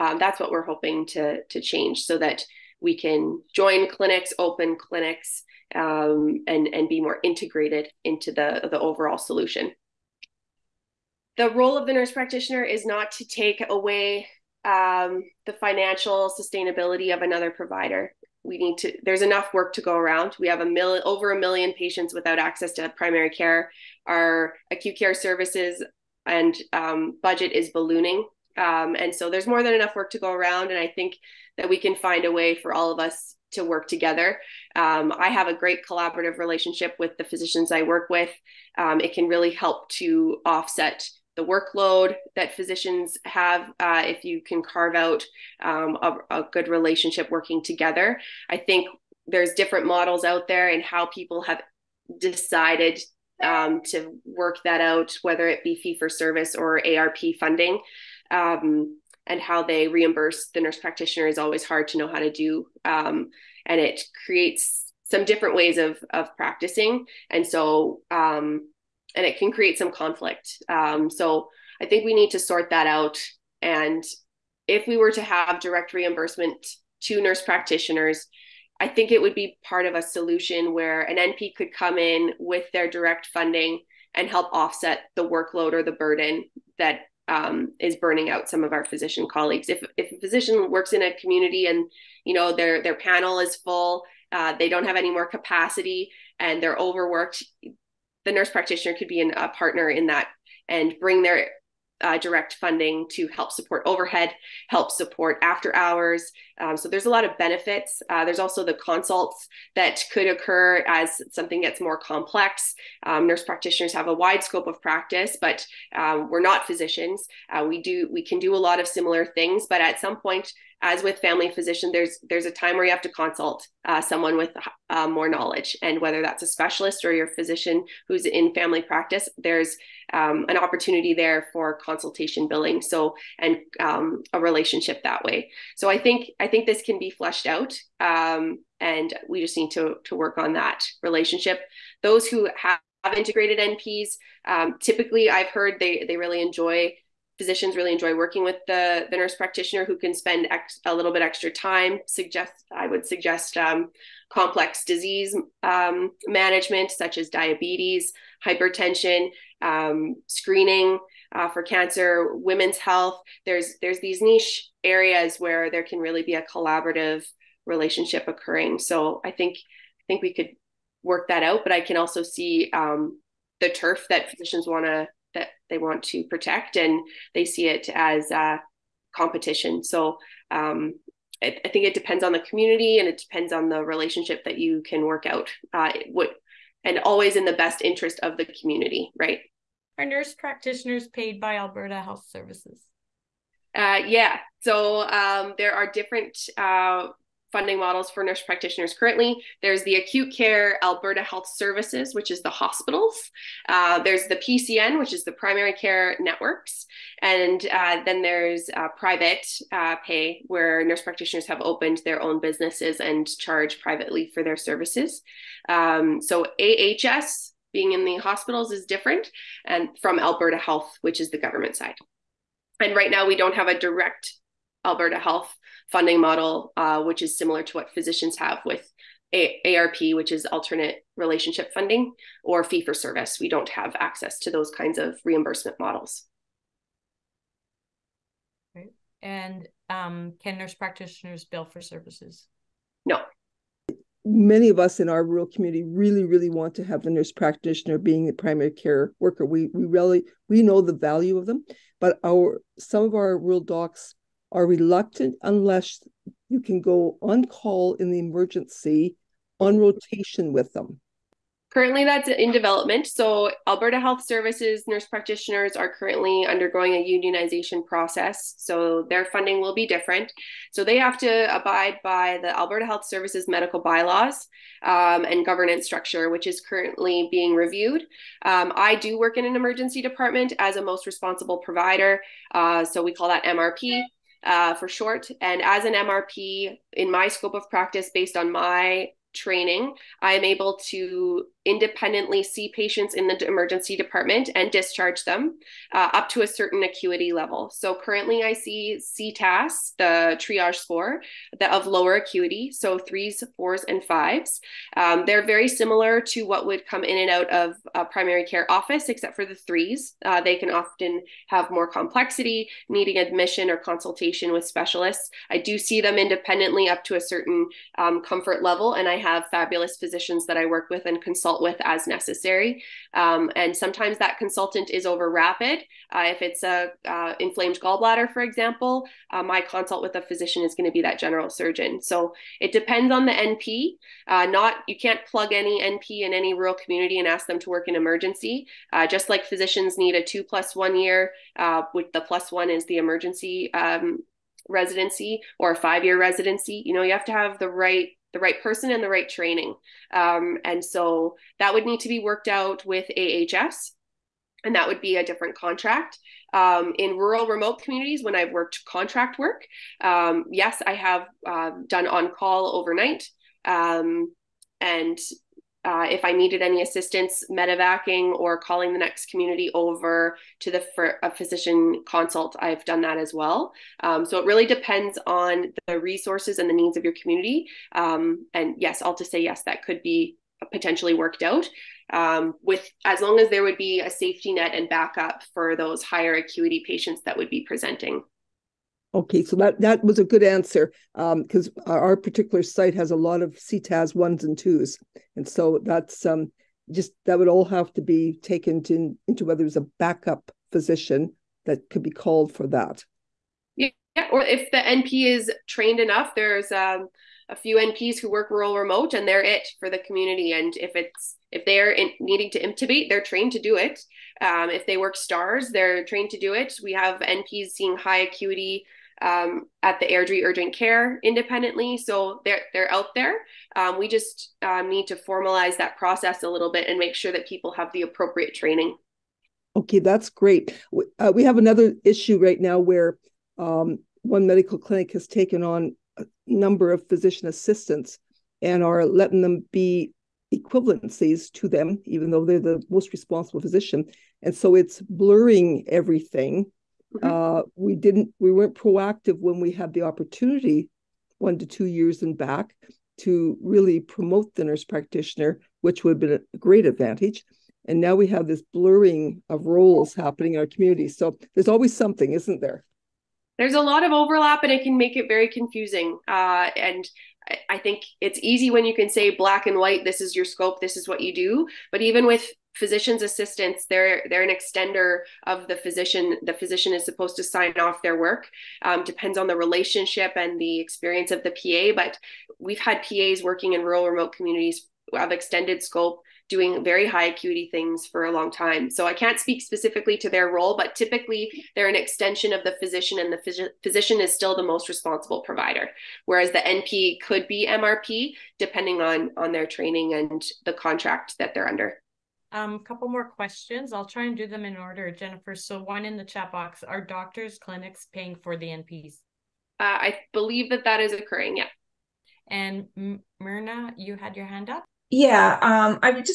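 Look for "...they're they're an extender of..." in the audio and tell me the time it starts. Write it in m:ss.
7:53.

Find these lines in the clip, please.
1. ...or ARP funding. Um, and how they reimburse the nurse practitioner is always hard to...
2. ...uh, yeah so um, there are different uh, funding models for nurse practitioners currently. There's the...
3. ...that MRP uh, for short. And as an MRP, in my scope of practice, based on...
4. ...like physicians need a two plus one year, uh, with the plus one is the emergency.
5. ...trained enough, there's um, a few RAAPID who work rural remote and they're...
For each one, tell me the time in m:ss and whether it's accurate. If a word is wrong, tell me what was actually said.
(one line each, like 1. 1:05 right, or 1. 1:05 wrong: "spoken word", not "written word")
1. 0:56 right
2. 3:13 right
3. 4:43 right
4. 5:39 right
5. 6:45 wrong: "NPs", not "RAAPID".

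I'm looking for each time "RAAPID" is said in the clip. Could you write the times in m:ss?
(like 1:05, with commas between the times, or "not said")
5:25.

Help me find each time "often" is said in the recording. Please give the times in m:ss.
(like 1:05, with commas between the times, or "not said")
5:10.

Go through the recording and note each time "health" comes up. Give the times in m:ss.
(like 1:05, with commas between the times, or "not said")
2:42, 3:12, 3:21, 3:40, 3:45, 4:24, 4:32.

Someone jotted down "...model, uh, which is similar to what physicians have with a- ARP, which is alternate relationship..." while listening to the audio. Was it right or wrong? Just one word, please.
right.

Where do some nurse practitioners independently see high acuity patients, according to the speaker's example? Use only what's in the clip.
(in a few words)
Airdrie Urgent Care.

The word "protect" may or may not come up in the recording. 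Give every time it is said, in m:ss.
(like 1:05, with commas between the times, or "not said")
2:56.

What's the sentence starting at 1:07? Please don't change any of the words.
And so, um, and it can create some conflict.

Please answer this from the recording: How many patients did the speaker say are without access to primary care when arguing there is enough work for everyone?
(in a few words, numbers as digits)
over a million.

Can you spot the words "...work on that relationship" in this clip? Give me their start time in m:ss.
2:20.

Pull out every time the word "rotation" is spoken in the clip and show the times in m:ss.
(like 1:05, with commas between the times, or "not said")
4:19.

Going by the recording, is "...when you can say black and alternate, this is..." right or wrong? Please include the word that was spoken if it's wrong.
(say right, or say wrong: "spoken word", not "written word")
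wrong: "white", not "alternate".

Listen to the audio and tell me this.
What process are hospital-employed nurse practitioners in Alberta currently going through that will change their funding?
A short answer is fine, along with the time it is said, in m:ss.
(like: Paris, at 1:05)
unionization, at 4:27.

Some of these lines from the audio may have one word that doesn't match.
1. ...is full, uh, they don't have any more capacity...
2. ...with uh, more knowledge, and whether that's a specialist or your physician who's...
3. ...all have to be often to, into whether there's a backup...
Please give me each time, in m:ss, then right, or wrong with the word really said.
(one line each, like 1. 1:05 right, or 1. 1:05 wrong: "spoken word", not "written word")
1. 1:33 right
2. 2:04 right
3. 6:37 wrong: "taken", not "often".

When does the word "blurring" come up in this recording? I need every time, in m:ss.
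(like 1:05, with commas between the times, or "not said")
7:25, 7:38.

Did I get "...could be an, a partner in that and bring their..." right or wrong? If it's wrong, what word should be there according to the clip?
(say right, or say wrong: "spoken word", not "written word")
right.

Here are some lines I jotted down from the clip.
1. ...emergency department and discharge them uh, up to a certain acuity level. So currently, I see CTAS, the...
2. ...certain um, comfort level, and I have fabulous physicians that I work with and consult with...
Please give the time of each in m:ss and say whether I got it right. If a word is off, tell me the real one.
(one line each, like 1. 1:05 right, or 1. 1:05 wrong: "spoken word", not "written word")
1. 4:53 right
2. 5:17 right.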